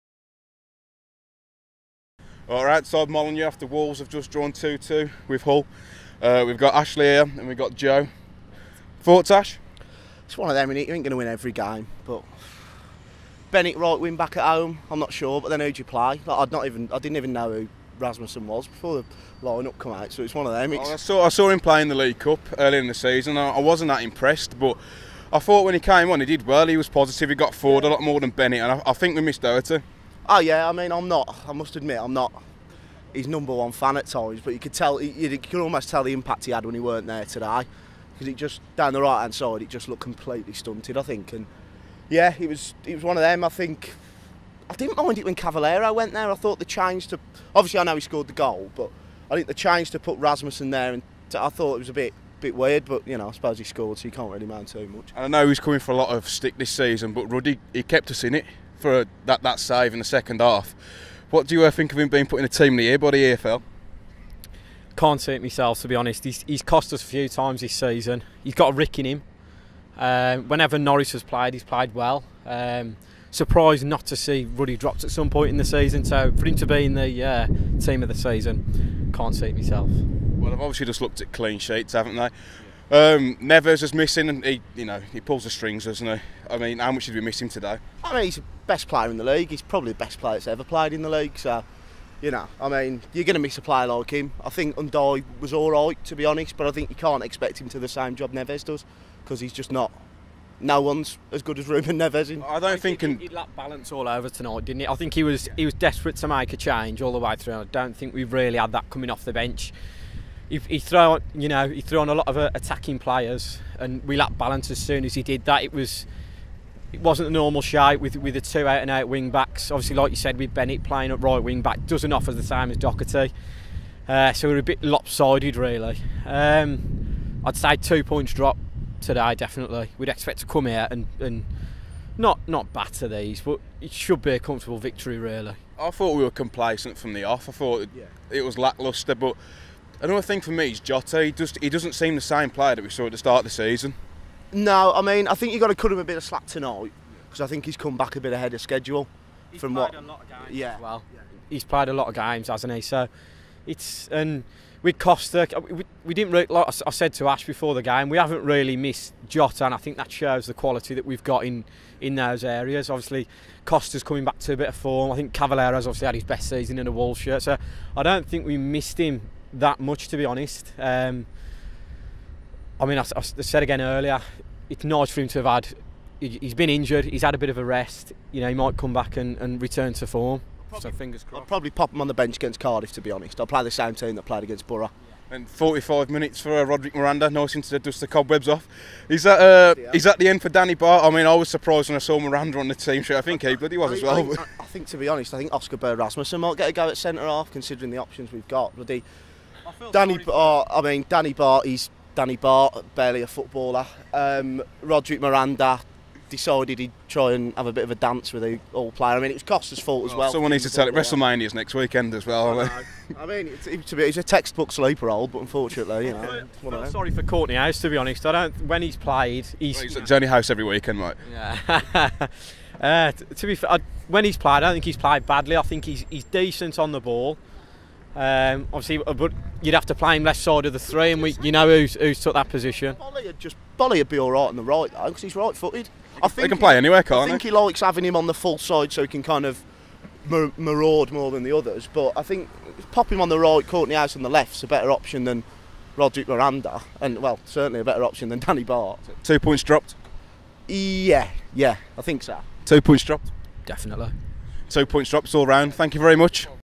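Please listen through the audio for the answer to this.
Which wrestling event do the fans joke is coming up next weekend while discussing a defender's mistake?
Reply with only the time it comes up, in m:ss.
3:30.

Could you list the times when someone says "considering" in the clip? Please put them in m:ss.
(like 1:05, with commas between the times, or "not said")
3:17.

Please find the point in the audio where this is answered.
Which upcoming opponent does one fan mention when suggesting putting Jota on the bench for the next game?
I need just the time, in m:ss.
3:02.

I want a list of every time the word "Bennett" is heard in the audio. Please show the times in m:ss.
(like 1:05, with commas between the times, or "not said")
0:13, 0:28, 2:00.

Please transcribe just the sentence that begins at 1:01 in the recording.
What do you uh, think of him being put in the team of the year by the EFL?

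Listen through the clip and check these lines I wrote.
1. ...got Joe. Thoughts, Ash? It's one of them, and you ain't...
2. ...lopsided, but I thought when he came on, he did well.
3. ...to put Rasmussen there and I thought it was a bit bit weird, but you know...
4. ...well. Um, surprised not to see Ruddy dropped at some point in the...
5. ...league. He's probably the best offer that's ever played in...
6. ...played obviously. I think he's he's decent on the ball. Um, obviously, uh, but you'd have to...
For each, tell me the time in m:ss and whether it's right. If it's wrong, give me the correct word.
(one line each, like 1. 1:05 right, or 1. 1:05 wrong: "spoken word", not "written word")
1. 0:07 right
2. 0:24 wrong: "impressed", not "lopsided"
3. 0:49 right
4. 1:11 right
5. 1:29 wrong: "player", not "offer"
6. 3:44 wrong: "badly", not "obviously".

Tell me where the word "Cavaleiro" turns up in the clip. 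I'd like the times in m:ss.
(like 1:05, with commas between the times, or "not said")
0:45, 2:45.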